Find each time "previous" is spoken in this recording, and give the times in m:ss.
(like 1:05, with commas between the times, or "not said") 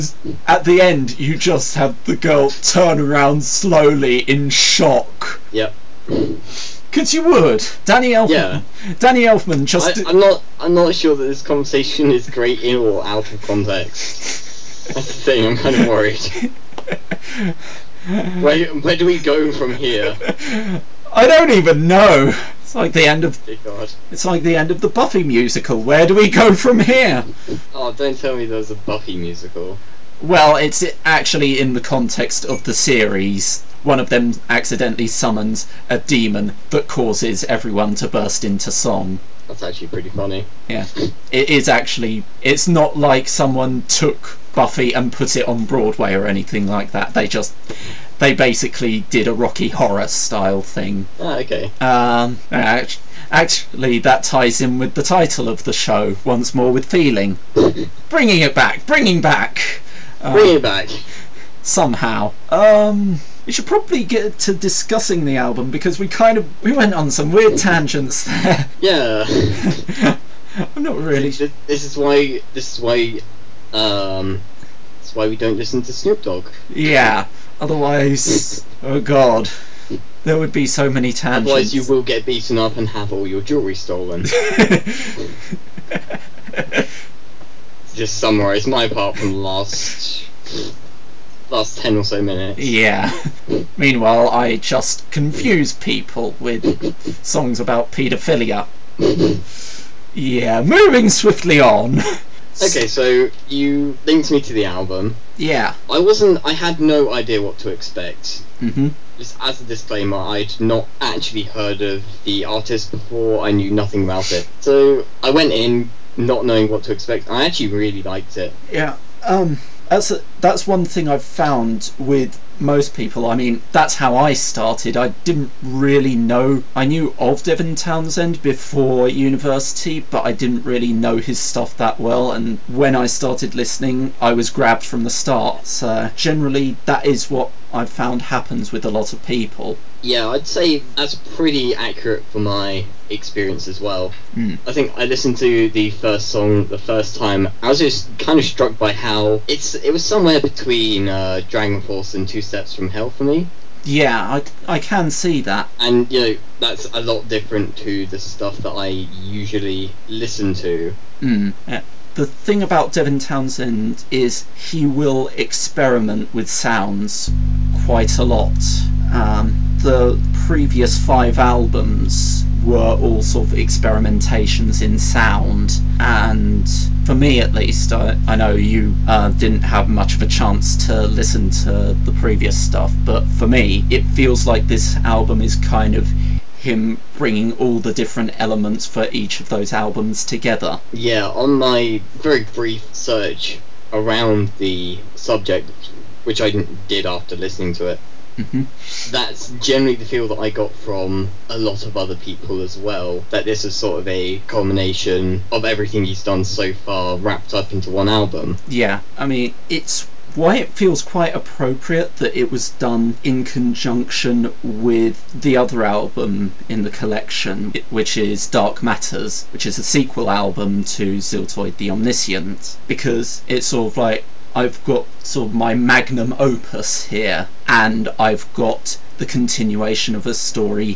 2:50, 3:02.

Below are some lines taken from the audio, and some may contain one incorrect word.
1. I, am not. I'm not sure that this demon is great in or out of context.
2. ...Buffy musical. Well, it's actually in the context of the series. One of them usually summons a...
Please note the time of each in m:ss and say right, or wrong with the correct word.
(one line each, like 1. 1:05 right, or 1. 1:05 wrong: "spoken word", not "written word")
1. 0:10 wrong: "conversation", not "demon"
2. 0:28 wrong: "accidentally", not "usually".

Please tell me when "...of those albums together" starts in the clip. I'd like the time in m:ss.
3:09.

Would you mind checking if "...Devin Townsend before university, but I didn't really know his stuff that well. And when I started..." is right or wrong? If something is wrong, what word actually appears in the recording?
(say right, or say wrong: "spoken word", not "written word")
right.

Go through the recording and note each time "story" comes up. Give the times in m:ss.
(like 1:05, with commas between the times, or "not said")
3:50.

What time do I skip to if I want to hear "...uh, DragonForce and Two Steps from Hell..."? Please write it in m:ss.
2:31.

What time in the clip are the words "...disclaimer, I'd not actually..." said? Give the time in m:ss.
1:49.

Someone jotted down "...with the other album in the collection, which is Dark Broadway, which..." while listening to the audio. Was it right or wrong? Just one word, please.
wrong.